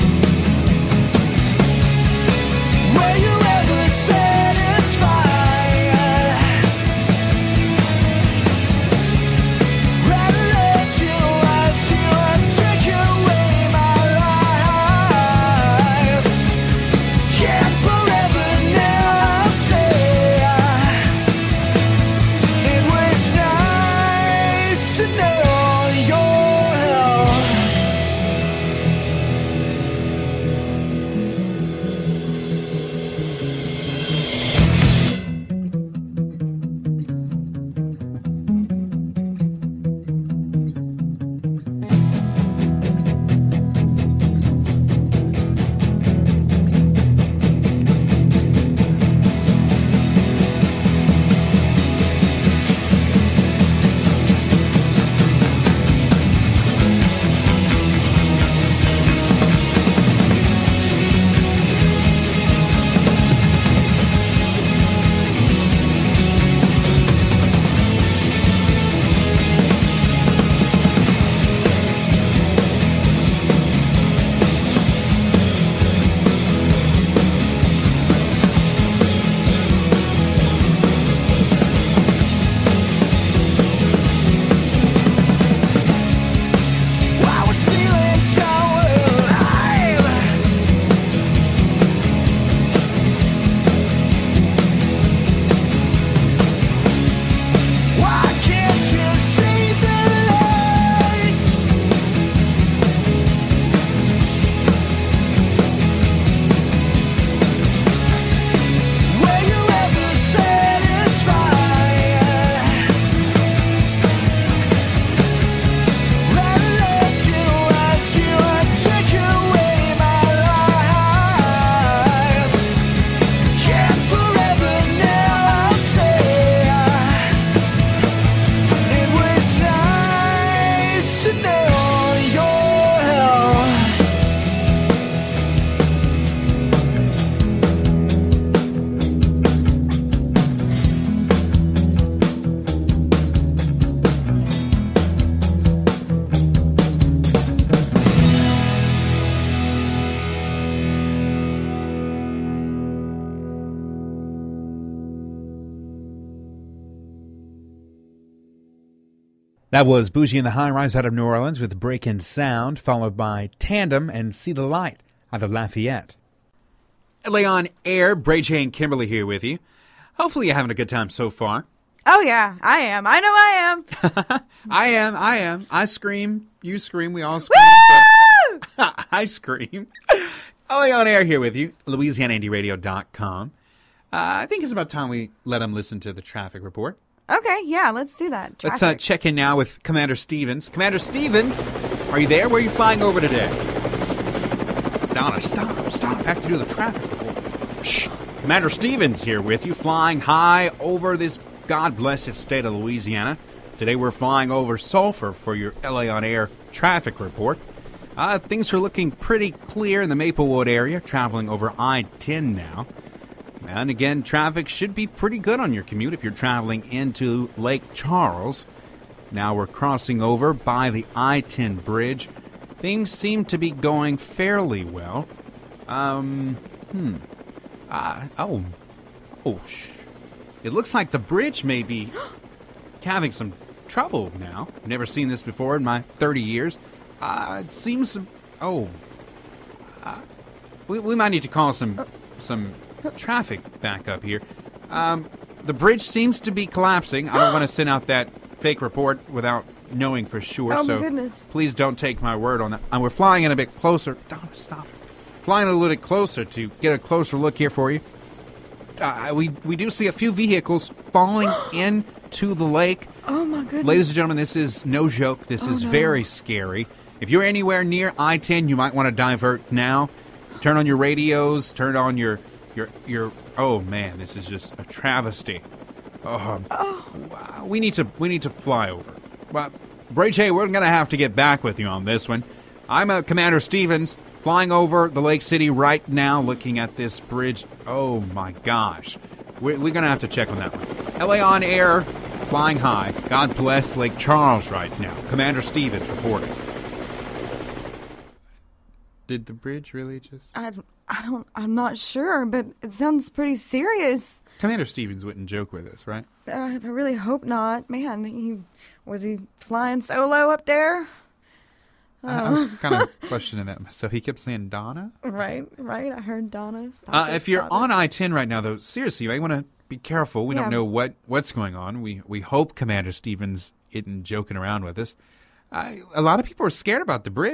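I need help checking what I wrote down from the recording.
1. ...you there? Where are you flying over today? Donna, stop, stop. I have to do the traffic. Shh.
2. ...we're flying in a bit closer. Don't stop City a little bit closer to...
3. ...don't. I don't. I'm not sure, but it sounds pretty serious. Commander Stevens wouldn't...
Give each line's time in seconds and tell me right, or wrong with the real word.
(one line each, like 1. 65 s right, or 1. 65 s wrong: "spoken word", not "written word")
1. 192 s right
2. 253 s wrong: "Flying", not "City"
3. 300 s right.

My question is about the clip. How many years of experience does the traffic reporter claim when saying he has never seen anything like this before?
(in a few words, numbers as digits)
30.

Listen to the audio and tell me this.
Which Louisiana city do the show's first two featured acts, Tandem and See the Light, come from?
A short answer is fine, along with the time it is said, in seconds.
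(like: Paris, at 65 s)
Lafayette, at 165 s.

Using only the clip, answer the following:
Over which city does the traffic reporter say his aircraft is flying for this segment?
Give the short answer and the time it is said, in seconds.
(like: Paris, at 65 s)
Sulphur, at 204 s.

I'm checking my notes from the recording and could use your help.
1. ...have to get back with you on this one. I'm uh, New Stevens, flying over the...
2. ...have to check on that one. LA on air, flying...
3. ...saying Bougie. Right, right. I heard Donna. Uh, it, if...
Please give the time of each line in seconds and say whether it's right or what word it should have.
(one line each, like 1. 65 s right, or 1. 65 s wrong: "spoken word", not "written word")
1. 280 s wrong: "Commander", not "New"
2. 290 s right
3. 314 s wrong: "Donna", not "Bougie".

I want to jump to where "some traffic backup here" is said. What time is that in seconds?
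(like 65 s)
242 s.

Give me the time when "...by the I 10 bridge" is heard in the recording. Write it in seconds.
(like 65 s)
220 s.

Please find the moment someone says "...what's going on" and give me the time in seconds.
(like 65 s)
321 s.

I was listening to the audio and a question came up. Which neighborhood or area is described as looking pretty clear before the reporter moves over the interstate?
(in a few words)
Maplewood.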